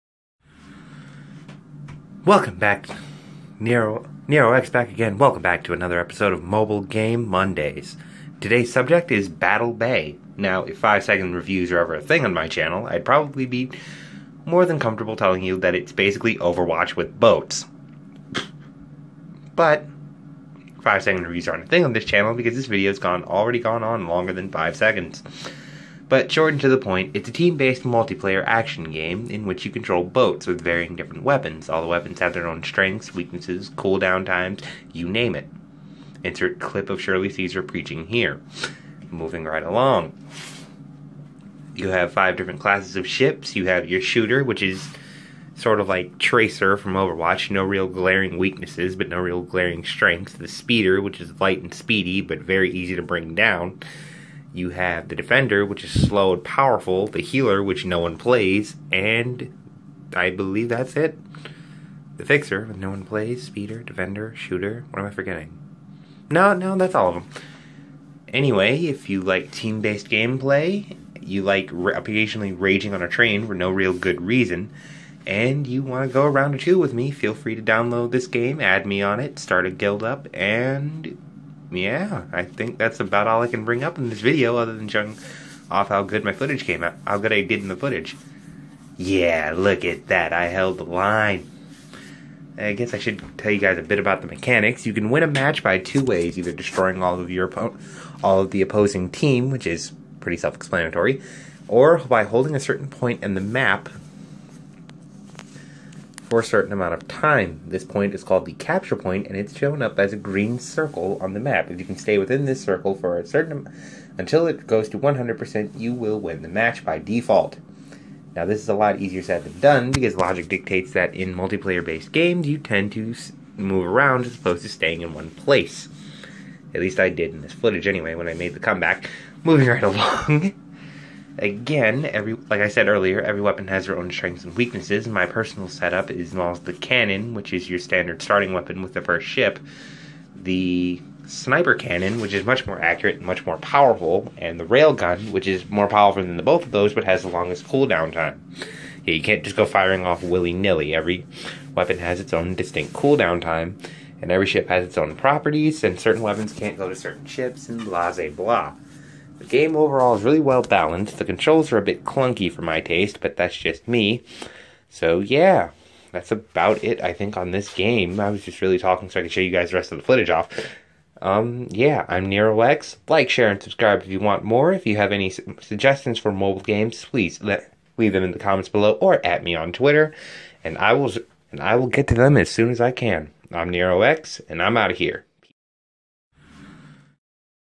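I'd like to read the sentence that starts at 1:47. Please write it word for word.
This point is called the capture point, and it's shown up as a green circle on the map.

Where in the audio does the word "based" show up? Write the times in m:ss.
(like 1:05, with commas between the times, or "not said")
0:27, 1:09, 2:01.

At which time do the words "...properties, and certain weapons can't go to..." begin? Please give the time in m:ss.
2:35.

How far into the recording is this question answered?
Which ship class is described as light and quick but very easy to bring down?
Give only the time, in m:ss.
0:50.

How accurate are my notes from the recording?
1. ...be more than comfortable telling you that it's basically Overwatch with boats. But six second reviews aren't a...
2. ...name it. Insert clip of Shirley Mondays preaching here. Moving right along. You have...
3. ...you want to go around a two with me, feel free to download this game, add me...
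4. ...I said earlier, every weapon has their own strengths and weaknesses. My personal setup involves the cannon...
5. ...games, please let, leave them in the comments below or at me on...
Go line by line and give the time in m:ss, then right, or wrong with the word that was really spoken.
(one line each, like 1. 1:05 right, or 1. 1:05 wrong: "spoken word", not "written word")
1. 0:13 wrong: "five", not "six"
2. 0:35 wrong: "Caesar", not "Mondays"
3. 1:15 right
4. 2:12 right
5. 2:56 right.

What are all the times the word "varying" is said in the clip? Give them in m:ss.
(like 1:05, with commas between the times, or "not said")
0:30.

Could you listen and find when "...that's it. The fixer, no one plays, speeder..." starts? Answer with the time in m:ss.
1:00.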